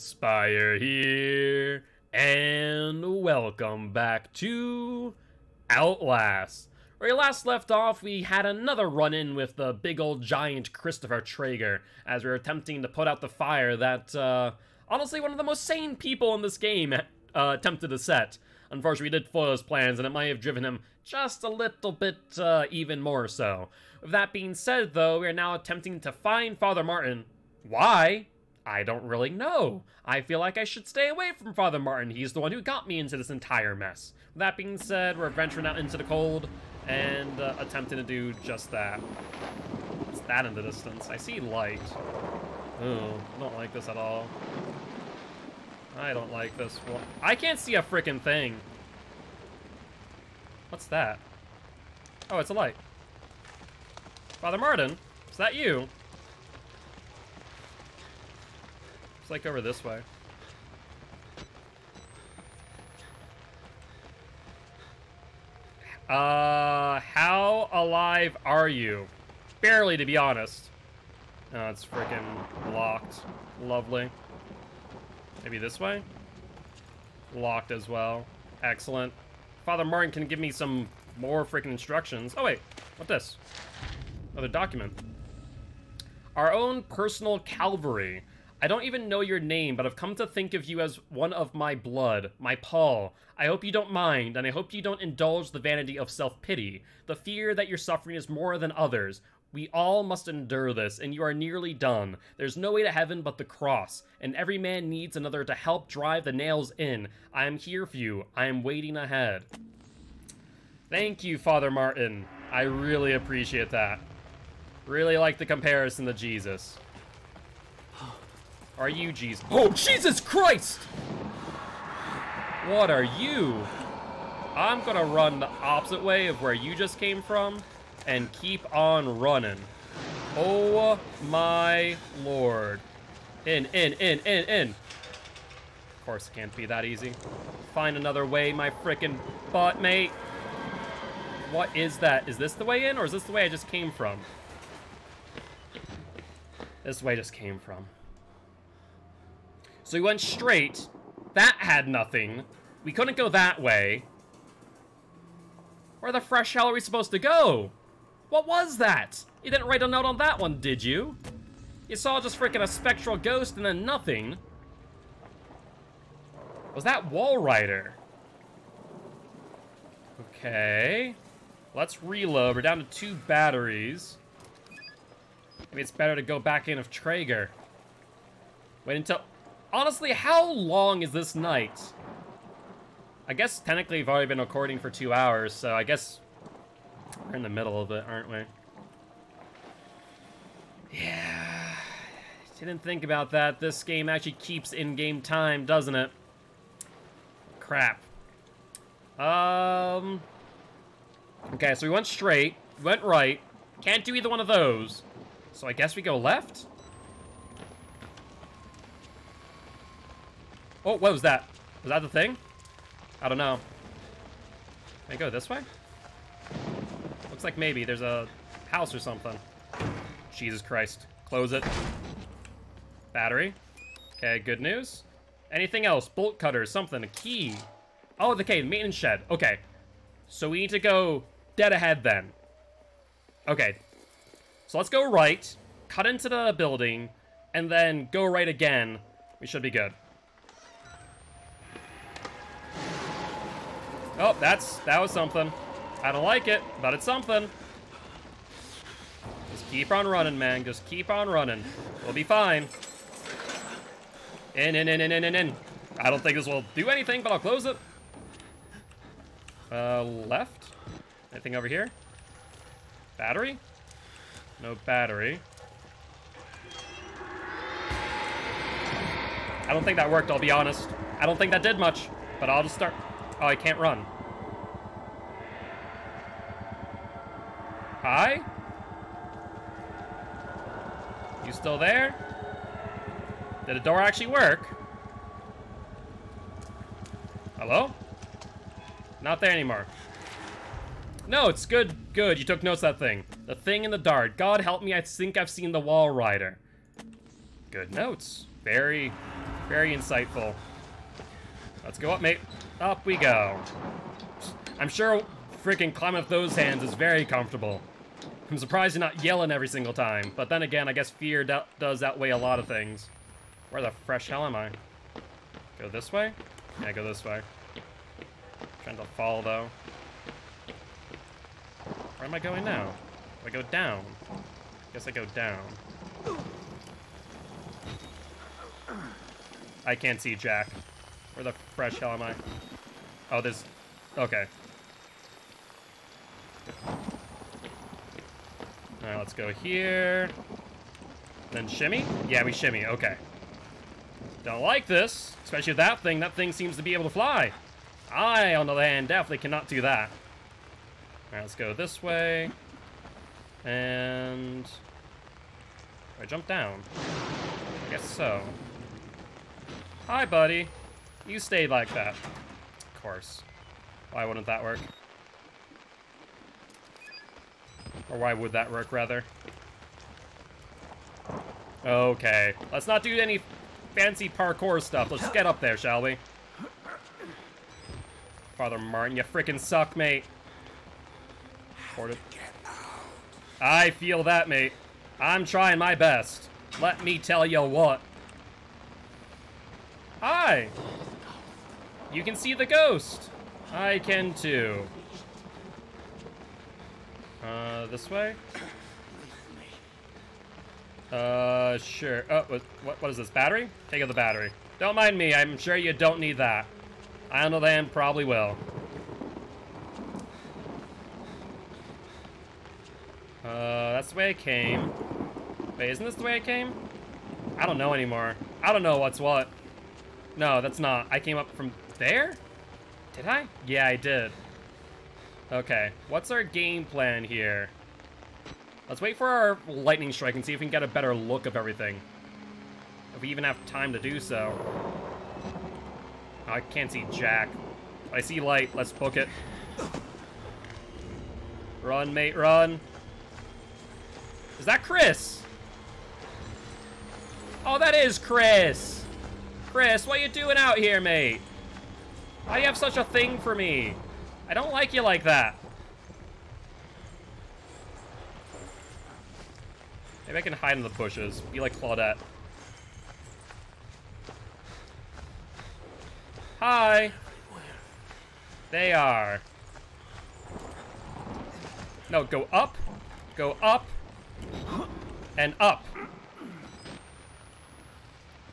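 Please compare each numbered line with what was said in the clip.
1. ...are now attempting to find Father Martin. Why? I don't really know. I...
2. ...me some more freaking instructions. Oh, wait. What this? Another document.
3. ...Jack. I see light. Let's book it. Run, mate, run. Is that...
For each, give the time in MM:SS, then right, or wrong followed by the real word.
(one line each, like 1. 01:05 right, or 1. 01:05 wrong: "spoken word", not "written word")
1. 00:25 right
2. 01:20 right
3. 07:17 right.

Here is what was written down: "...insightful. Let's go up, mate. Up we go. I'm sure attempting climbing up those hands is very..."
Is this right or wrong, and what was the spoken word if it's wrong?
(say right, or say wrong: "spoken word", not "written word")
wrong: "freaking", not "attempting".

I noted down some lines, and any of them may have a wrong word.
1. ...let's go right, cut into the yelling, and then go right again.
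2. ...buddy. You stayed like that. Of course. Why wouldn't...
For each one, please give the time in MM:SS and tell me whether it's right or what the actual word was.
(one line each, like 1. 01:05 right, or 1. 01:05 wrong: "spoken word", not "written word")
1. 03:54 wrong: "building", not "yelling"
2. 06:00 right.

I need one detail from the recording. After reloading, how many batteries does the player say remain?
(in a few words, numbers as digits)
2.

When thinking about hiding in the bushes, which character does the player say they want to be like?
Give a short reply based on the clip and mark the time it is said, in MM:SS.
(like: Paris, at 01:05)
Claudette, at 07:41.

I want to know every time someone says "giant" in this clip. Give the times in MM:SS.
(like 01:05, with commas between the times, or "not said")
00:10.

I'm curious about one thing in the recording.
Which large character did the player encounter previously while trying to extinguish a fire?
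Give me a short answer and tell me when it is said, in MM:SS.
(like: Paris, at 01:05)
Christopher Traeger, at 00:10.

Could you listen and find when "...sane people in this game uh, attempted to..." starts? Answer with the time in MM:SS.
00:15.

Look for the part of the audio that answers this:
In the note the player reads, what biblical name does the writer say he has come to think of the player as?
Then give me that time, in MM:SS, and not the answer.
01:32.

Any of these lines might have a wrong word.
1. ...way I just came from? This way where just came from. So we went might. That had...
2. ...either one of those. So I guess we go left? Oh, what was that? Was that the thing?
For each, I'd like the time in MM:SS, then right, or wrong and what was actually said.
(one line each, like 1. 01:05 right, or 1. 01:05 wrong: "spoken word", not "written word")
1. 02:23 wrong: "straight", not "might"
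2. 03:24 right.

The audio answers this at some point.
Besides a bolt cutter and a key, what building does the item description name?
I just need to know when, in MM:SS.
03:48.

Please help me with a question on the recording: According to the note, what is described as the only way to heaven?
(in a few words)
the cross.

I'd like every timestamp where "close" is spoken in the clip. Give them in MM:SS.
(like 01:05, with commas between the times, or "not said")
03:41, 04:17.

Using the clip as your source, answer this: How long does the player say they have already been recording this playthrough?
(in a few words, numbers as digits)
two hours.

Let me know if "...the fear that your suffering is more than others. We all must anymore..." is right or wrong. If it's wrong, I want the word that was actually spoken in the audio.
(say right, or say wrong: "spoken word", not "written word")
wrong: "endure", not "anymore".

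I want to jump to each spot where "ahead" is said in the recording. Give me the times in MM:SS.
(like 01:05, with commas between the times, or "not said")
01:48, 03:51.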